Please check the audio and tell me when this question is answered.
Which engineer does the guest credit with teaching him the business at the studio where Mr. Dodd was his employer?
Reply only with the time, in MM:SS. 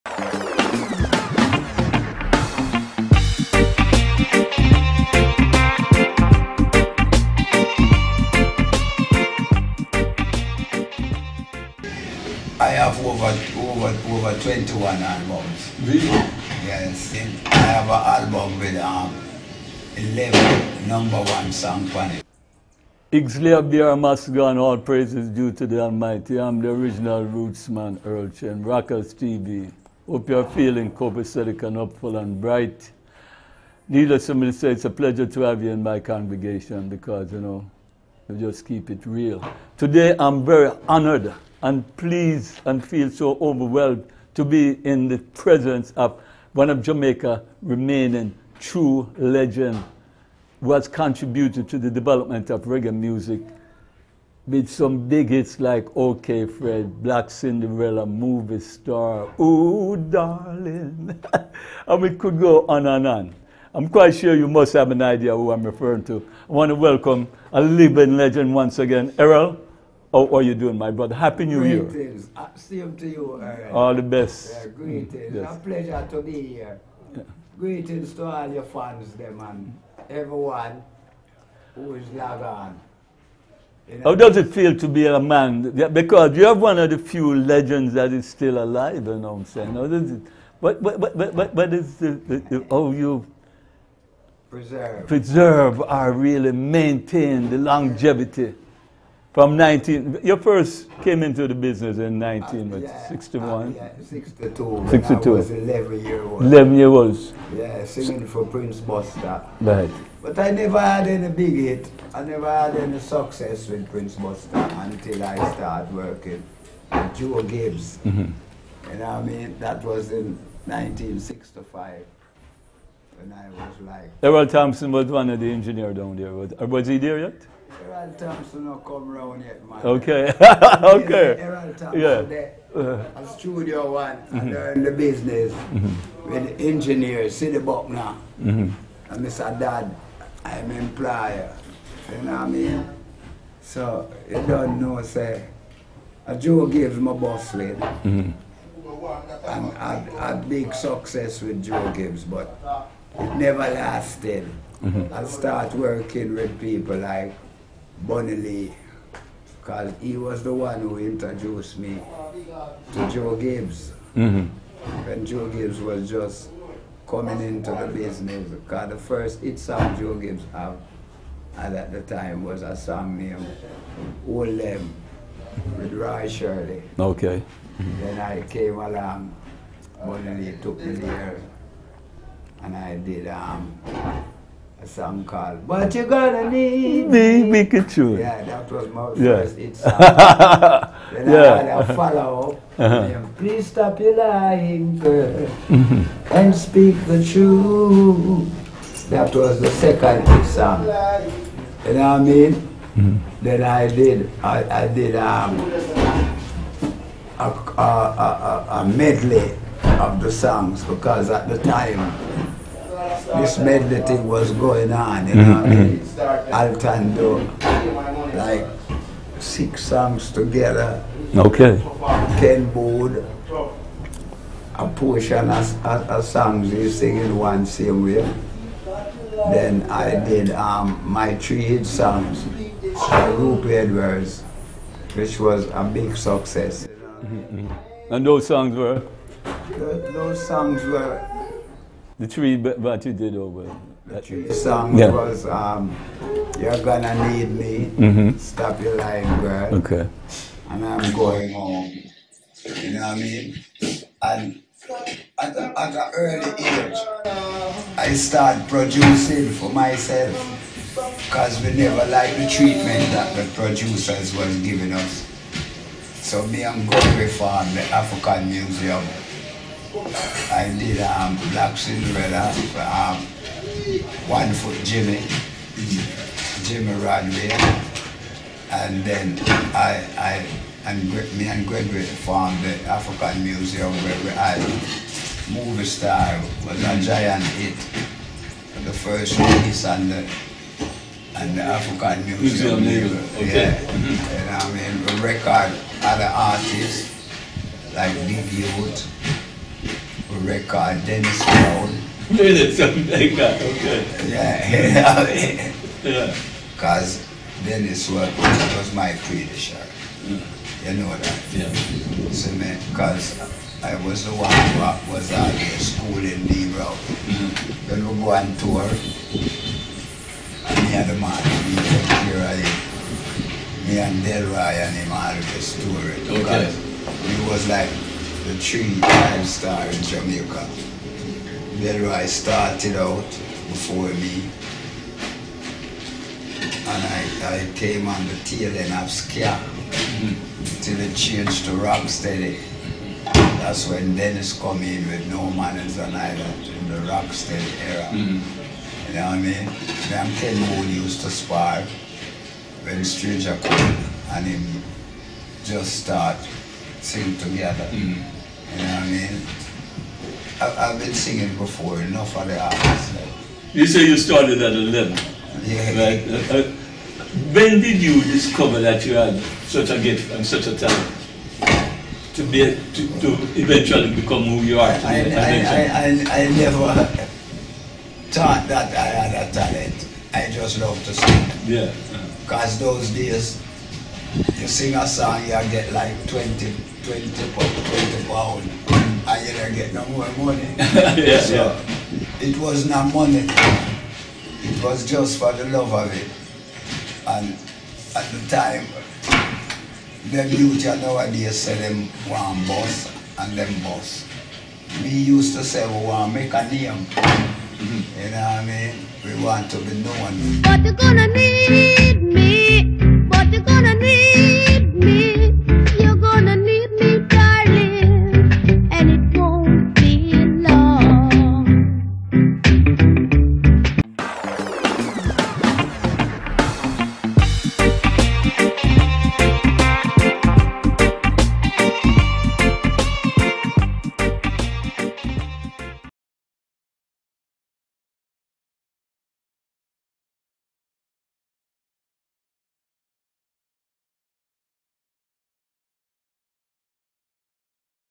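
02:17.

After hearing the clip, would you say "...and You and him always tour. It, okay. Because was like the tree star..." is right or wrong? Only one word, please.
wrong.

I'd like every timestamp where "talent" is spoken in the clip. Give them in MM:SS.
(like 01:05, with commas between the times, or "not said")
06:10, 06:19.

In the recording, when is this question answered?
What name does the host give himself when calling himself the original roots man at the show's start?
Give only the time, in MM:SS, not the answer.
00:28.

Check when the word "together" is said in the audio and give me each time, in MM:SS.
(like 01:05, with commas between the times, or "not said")
03:40, 05:57.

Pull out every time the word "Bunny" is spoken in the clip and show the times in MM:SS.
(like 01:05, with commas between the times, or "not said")
02:38, 03:00.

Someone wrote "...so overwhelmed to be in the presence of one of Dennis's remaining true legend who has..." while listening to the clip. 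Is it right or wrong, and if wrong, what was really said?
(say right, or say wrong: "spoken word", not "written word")
wrong: "Jamaica", not "Dennis".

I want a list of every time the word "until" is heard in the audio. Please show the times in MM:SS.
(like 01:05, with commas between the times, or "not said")
01:54.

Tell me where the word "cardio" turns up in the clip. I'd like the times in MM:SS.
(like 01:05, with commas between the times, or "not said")
not said.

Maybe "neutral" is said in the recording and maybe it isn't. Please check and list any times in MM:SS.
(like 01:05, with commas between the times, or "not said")
not said.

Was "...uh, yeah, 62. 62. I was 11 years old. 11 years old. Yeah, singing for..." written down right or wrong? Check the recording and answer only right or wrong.
right.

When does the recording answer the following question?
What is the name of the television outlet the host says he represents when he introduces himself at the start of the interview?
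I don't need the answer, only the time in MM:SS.
00:28.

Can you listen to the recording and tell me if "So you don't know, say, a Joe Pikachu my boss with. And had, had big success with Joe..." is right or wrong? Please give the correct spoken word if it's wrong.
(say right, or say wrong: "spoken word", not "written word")
wrong: "Gibbs", not "Pikachu".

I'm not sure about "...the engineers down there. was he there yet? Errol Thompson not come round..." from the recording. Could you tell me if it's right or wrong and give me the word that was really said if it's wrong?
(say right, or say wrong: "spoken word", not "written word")
right.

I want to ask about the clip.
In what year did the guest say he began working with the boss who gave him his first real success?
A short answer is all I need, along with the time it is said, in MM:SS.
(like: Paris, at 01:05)
1965, at 02:00.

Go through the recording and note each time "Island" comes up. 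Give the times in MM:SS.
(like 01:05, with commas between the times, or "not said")
05:46.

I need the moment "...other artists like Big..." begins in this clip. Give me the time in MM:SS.
04:55.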